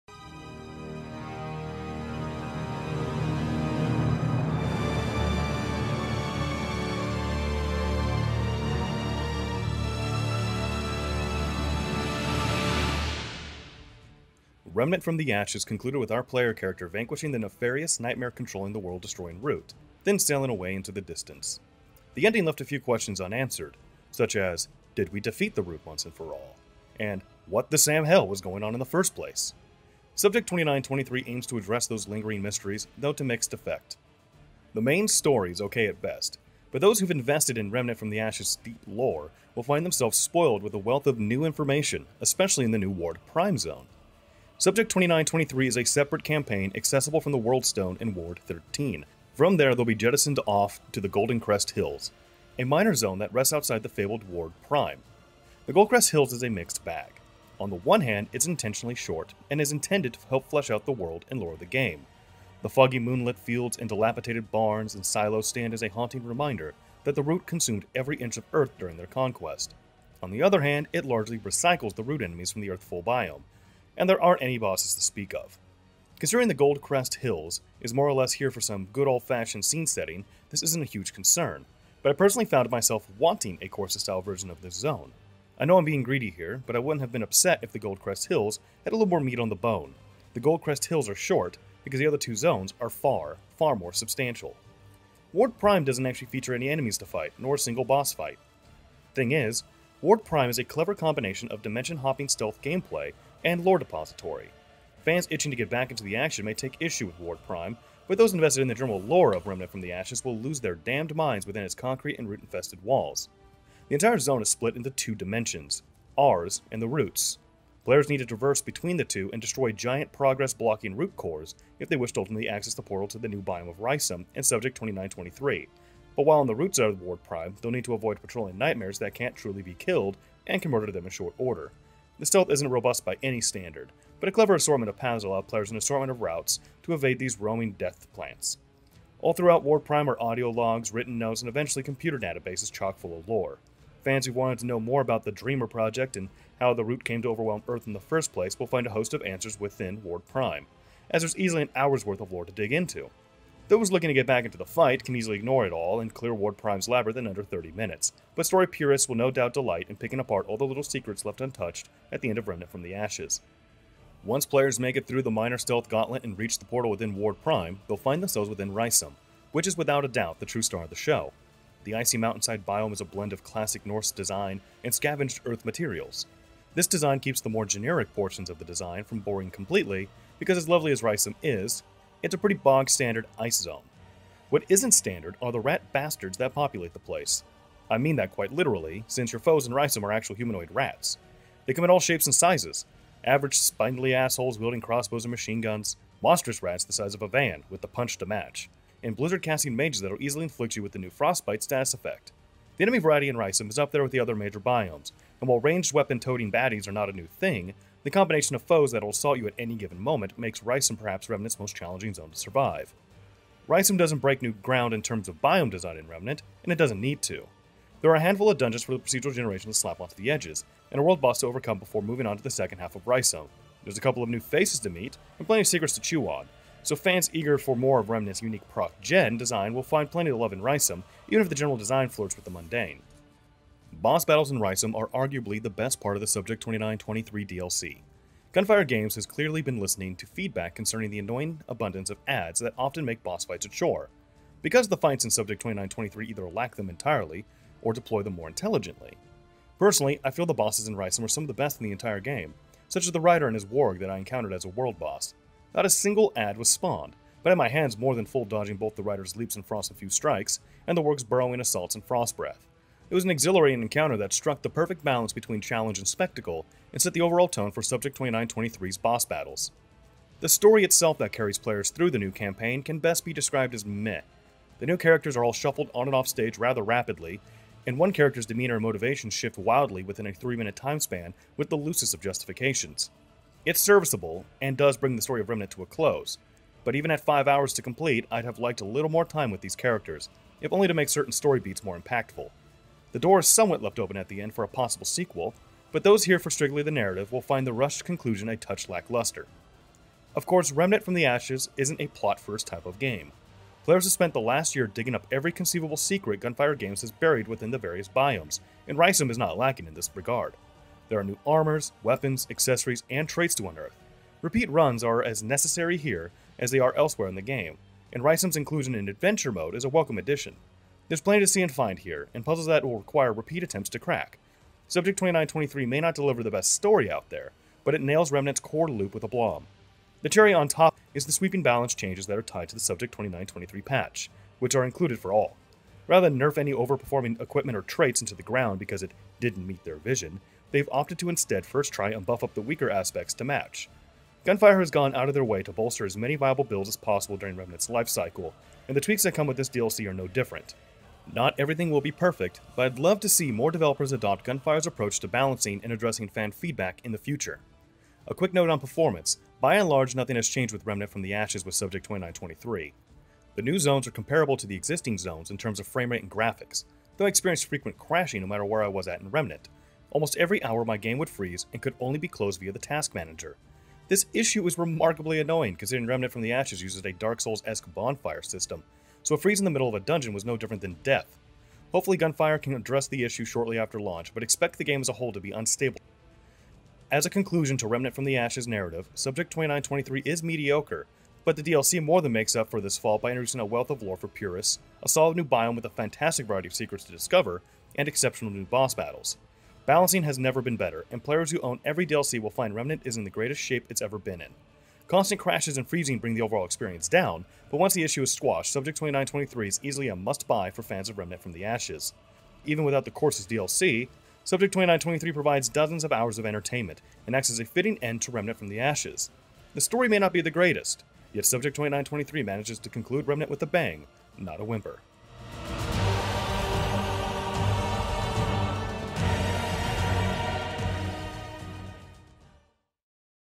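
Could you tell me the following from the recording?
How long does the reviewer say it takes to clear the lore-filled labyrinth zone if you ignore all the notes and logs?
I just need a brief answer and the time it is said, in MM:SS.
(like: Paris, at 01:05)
under 30 minutes, at 02:37.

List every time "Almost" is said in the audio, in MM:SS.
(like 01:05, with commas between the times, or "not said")
06:10.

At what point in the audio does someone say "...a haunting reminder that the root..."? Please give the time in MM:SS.
01:05.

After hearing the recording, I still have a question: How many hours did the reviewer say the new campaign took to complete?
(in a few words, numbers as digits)
5.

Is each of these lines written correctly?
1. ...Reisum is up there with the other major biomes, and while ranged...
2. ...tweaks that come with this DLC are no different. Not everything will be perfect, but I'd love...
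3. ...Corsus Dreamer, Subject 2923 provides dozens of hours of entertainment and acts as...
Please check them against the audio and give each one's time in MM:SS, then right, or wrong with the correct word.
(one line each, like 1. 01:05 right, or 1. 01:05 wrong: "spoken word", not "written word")
1. 03:23 right
2. 05:49 right
3. 06:53 wrong: "DLC", not "Dreamer".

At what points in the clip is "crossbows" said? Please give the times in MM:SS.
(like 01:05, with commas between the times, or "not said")
03:14.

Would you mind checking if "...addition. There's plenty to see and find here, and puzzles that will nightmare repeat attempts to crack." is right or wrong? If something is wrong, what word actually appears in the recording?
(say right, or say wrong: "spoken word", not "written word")
wrong: "require", not "nightmare".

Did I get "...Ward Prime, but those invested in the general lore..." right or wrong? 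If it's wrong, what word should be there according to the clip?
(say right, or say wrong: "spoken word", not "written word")
right.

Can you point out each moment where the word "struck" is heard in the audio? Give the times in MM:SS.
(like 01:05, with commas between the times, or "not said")
04:24.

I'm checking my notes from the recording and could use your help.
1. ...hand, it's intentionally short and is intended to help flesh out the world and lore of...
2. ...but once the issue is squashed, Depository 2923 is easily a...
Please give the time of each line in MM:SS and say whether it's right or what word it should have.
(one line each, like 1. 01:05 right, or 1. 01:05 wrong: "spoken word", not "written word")
1. 00:58 right
2. 06:47 wrong: "Subject", not "Depository".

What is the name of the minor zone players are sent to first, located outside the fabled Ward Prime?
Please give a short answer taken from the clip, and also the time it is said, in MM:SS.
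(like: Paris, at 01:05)
Golden Crest Hills, at 00:51.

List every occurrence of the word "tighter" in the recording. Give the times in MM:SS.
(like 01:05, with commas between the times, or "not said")
not said.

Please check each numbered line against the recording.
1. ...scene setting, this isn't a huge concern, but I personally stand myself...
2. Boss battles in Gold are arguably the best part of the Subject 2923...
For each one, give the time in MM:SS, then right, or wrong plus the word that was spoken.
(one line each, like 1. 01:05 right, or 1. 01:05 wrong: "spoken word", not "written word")
1. 01:19 wrong: "found", not "stand"
2. 03:54 wrong: "Reisum", not "Gold".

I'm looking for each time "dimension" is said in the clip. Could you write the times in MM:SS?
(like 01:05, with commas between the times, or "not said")
01:41, 01:55.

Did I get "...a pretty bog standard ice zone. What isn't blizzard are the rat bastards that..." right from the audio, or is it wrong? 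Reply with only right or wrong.
wrong.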